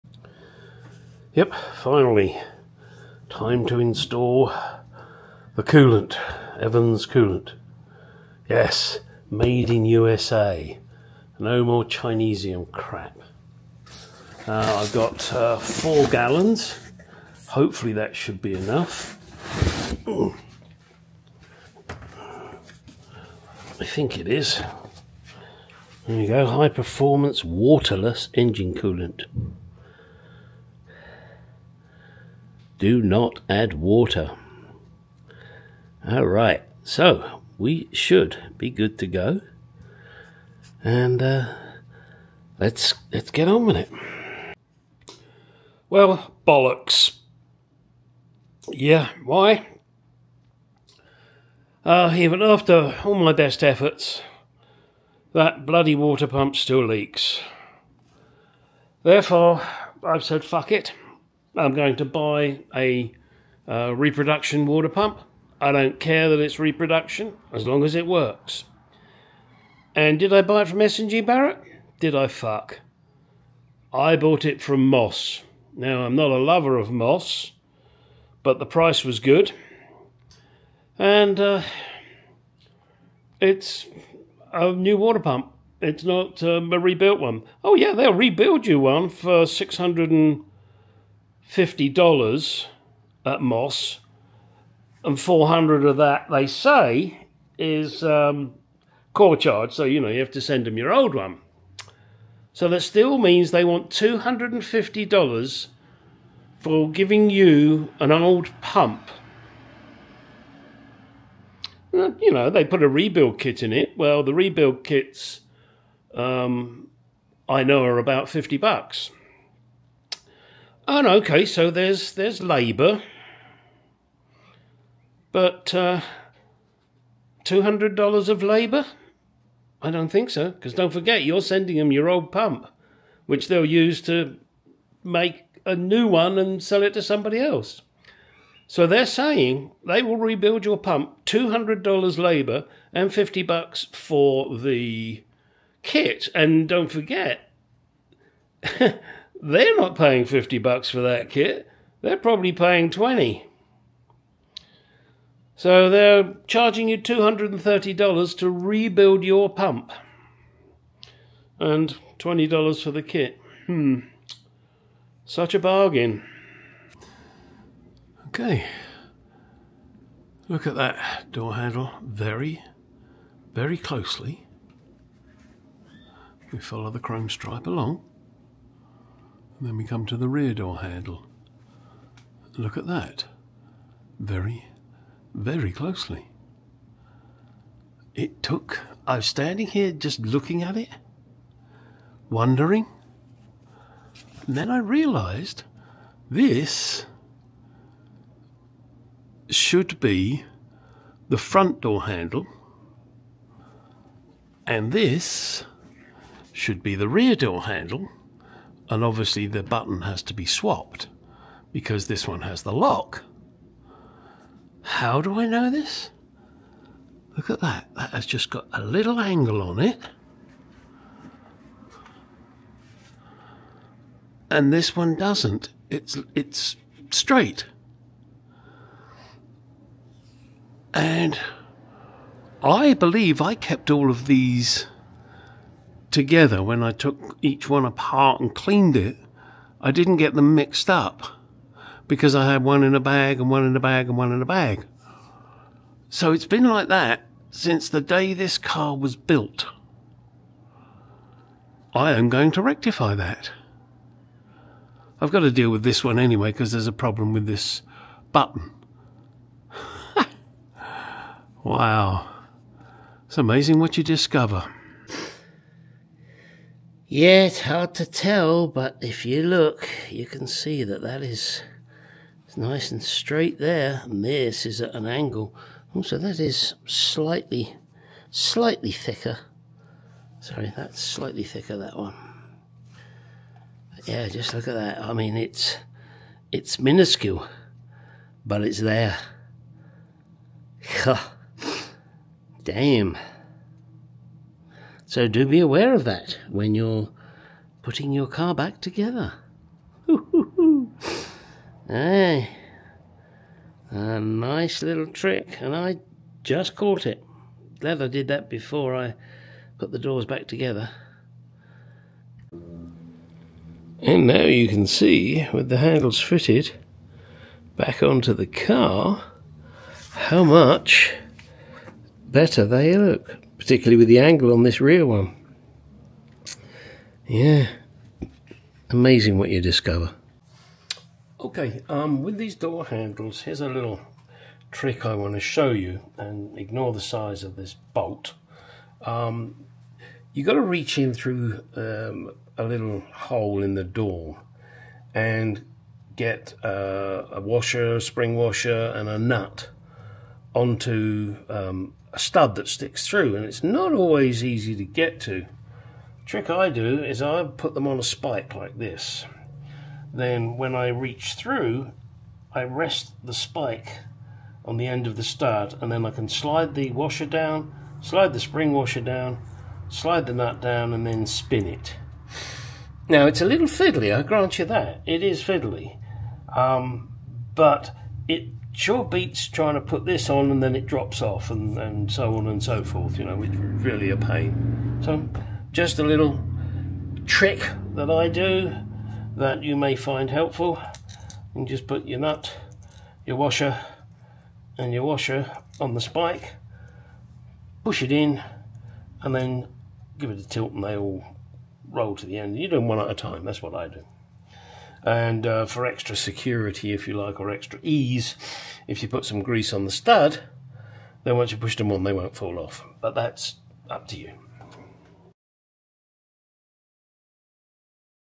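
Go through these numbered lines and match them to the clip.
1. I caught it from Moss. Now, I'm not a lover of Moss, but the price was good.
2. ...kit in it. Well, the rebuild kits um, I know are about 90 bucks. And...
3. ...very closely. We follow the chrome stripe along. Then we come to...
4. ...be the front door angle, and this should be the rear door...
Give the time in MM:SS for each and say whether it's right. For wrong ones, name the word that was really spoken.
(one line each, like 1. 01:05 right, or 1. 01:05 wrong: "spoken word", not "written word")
1. 01:13 wrong: "bought", not "caught"
2. 01:53 wrong: "50", not "90"
3. 02:53 right
4. 03:19 wrong: "handle", not "angle".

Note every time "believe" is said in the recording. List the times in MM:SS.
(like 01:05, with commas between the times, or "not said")
03:52.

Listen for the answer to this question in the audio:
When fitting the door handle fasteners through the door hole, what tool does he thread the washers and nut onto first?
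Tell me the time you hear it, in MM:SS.
05:57.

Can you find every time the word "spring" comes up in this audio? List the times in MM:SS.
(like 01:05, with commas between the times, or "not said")
05:47, 06:08.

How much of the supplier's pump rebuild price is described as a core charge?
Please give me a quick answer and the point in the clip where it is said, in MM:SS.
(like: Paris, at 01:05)
400, at 01:35.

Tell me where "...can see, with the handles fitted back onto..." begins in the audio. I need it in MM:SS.
05:14.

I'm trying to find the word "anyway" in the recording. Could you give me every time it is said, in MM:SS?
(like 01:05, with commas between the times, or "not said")
04:16.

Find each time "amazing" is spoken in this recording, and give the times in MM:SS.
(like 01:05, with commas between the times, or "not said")
04:23, 05:28.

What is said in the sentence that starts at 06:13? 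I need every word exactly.
Now it's a little fiddly, I grant you that.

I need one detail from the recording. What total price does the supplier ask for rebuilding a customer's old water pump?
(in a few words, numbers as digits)
$650.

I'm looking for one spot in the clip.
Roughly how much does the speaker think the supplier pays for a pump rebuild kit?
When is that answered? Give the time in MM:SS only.
02:32.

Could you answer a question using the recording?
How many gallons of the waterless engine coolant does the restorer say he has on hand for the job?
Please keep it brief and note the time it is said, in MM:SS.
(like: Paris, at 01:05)
4, at 00:15.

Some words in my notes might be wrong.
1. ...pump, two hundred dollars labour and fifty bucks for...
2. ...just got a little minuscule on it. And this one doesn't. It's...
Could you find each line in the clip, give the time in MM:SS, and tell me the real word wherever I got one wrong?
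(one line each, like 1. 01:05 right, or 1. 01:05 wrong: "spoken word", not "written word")
1. 02:20 right
2. 03:38 wrong: "angle", not "minuscule".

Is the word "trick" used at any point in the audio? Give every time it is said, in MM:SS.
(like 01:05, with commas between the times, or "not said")
05:05, 05:34, 05:56, 06:27.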